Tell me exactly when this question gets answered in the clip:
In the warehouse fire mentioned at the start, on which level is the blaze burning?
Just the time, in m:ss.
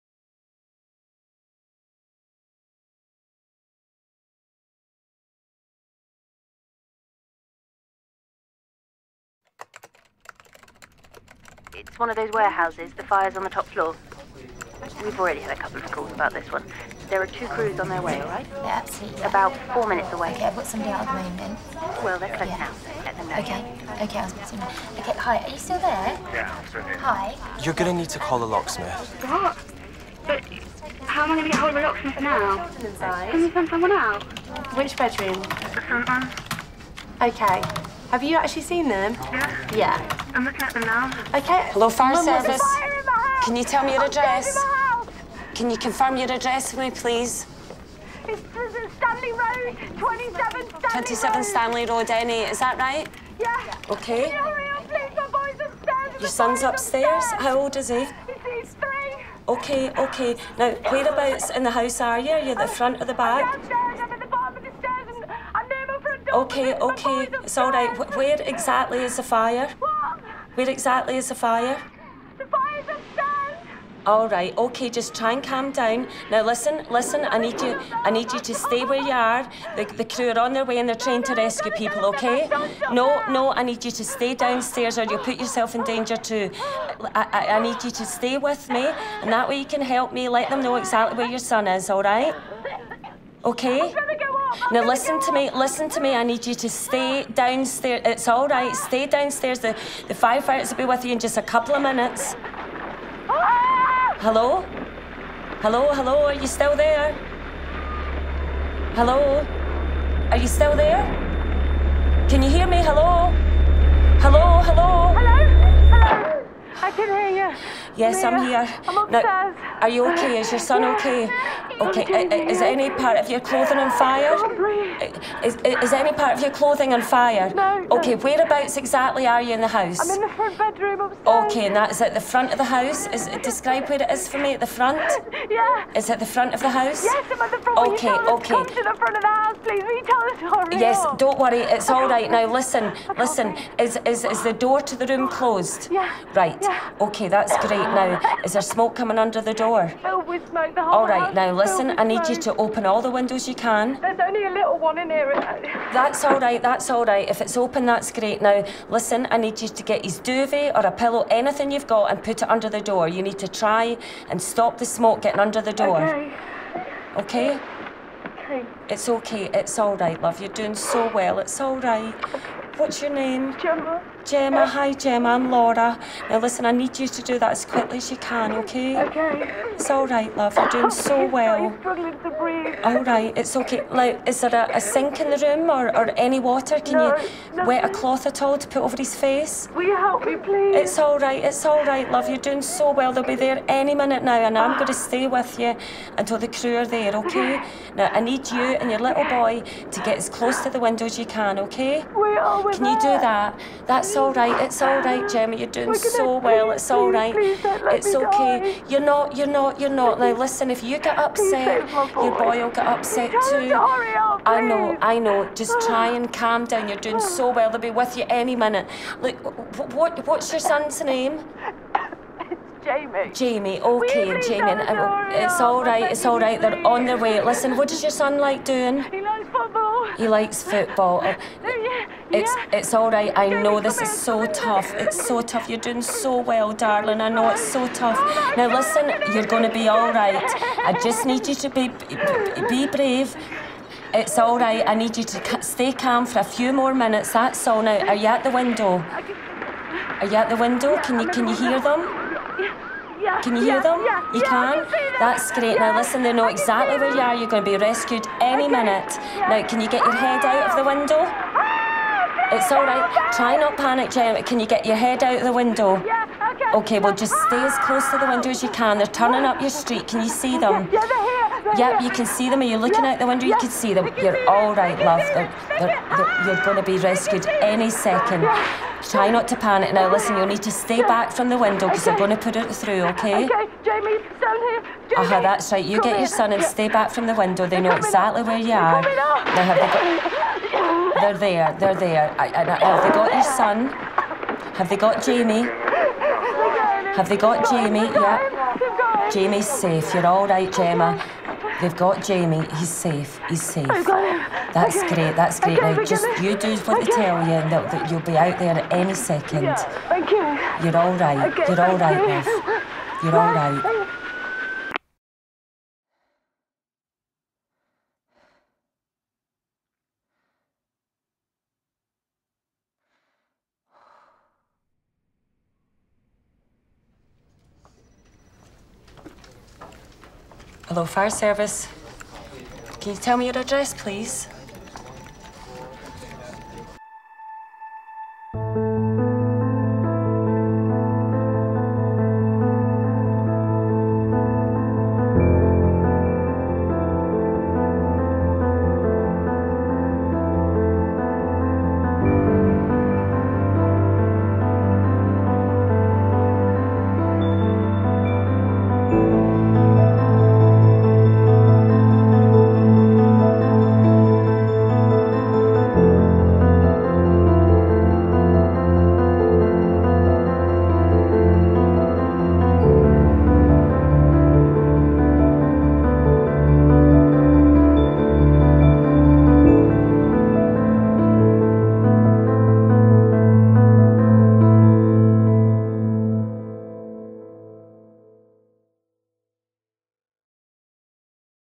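0:13.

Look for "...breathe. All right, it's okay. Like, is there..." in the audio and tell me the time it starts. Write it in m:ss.
3:02.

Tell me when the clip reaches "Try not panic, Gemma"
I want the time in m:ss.
4:23.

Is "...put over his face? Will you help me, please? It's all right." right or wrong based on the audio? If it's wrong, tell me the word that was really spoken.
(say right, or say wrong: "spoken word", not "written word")
right.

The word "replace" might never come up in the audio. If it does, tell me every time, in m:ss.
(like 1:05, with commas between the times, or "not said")
not said.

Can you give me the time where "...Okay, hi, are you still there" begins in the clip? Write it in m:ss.
0:24.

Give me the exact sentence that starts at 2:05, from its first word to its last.
Is, is any part of your clothing on fire?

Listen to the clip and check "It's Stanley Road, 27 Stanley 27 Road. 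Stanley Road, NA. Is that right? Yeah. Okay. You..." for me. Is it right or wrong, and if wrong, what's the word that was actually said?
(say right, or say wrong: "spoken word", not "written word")
right.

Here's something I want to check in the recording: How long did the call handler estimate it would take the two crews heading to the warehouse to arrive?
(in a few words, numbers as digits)
4 minutes.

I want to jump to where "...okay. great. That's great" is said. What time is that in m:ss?
5:04.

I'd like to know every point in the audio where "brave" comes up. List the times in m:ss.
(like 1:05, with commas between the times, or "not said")
4:02.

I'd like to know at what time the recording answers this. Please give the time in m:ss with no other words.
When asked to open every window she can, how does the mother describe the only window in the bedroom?
2:34.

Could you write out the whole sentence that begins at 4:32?
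Are you looking yeah, out the window?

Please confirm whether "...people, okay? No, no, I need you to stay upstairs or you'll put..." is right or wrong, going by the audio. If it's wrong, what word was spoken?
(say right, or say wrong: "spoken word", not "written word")
wrong: "downstairs", not "upstairs".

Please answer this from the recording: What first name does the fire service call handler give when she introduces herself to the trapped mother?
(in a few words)
Laura.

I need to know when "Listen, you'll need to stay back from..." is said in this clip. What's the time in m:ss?
4:40.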